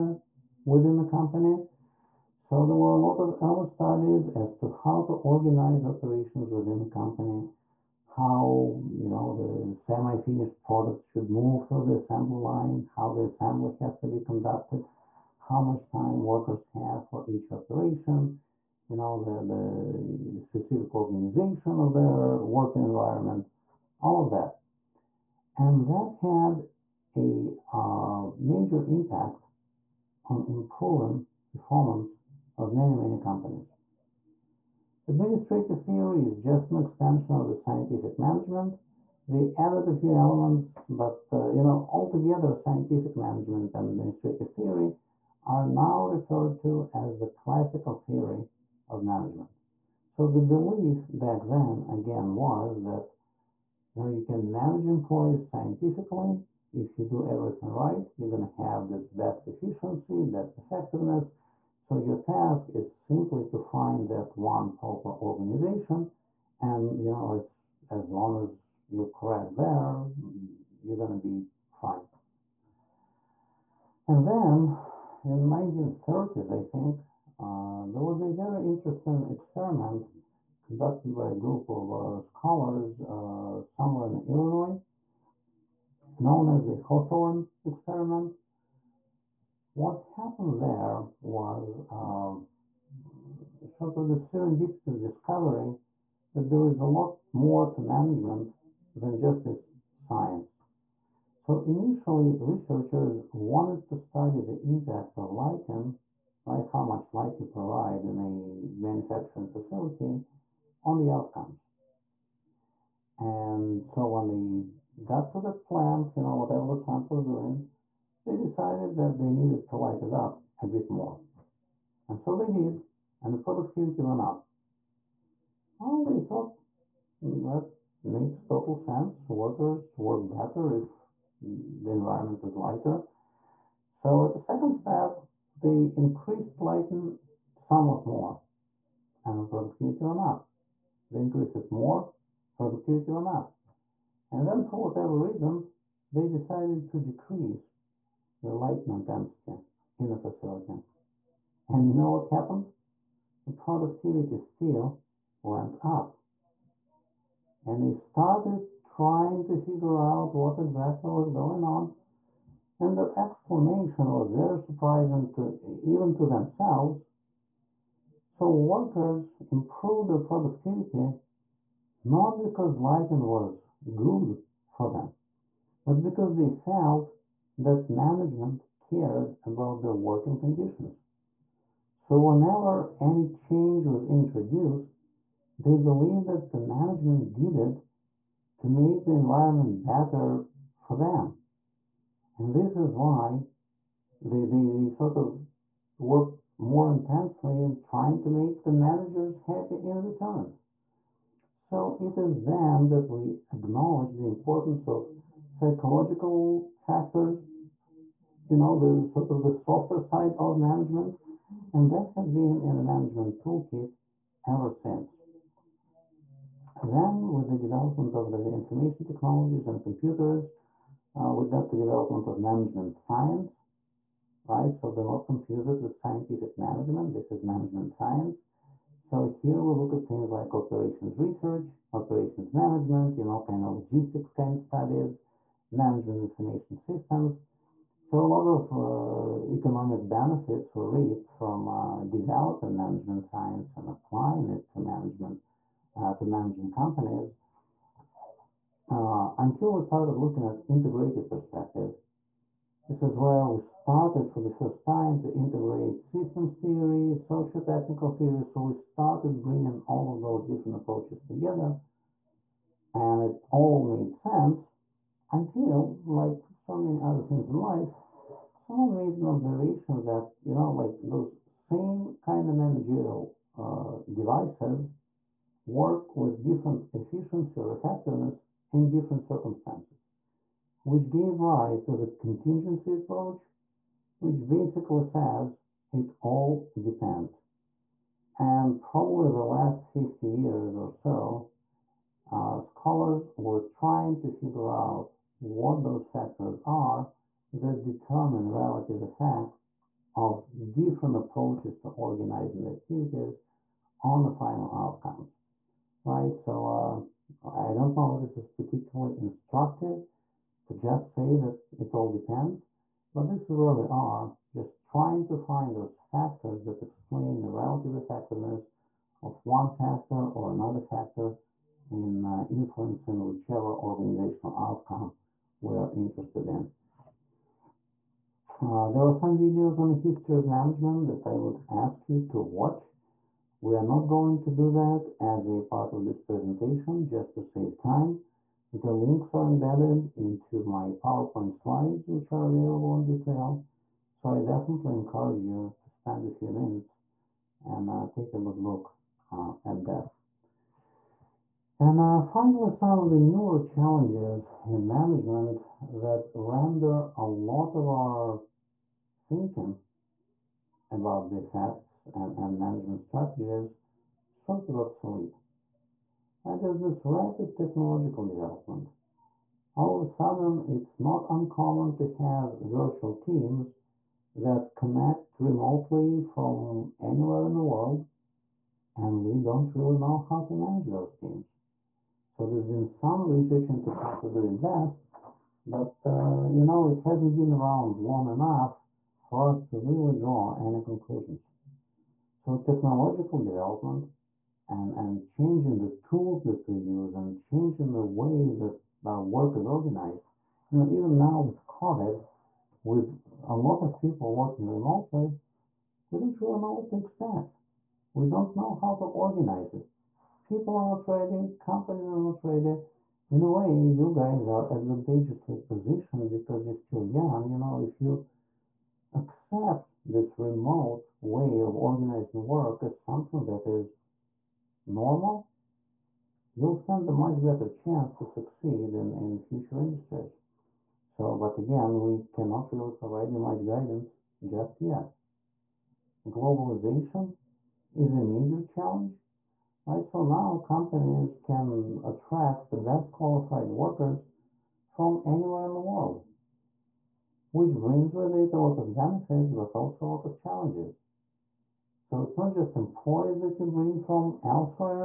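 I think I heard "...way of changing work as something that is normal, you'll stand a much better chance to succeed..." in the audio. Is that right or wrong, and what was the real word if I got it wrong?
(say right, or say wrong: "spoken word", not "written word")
wrong: "organizing", not "changing".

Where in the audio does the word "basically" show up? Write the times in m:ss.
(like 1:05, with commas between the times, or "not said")
4:44.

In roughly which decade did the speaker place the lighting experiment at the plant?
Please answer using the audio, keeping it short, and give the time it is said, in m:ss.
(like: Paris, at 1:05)
1930s, at 1:15.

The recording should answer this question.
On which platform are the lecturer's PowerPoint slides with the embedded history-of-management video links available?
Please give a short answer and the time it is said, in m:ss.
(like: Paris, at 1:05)
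D2L, at 5:43.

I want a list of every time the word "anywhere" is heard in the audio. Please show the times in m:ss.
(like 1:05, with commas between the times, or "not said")
6:16, 7:25.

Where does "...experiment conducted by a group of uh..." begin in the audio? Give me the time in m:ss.
1:19.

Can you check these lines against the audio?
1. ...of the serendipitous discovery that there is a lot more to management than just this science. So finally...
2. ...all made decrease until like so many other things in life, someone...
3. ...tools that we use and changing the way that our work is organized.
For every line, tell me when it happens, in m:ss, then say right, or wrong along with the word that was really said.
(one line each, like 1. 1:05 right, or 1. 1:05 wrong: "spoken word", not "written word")
1. 1:33 wrong: "initially", not "finally"
2. 4:23 wrong: "sense", not "decrease"
3. 6:36 right.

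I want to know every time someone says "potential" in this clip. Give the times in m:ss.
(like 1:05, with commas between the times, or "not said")
not said.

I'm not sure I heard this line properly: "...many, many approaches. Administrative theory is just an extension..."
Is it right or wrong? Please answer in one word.
wrong.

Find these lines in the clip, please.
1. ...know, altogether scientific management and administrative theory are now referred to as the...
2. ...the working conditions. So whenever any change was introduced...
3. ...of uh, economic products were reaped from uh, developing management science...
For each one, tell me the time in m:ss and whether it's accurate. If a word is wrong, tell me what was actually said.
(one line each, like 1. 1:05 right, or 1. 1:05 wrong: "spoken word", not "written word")
1. 0:41 right
2. 2:59 right
3. 3:58 wrong: "benefits", not "products".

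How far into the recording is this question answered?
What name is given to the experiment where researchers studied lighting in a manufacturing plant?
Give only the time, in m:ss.
1:26.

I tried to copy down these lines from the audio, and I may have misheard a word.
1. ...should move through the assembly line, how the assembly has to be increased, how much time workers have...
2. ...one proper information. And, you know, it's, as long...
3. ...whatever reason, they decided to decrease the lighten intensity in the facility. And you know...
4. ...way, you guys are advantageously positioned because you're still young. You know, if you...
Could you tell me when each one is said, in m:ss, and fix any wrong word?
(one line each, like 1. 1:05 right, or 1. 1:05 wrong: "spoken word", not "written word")
1. 0:11 wrong: "conducted", not "increased"
2. 1:04 wrong: "organization", not "information"
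3. 2:24 right
4. 6:53 right.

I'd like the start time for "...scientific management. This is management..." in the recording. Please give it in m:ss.
3:45.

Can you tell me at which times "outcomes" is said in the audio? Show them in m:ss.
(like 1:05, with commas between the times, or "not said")
1:51, 5:04, 5:24.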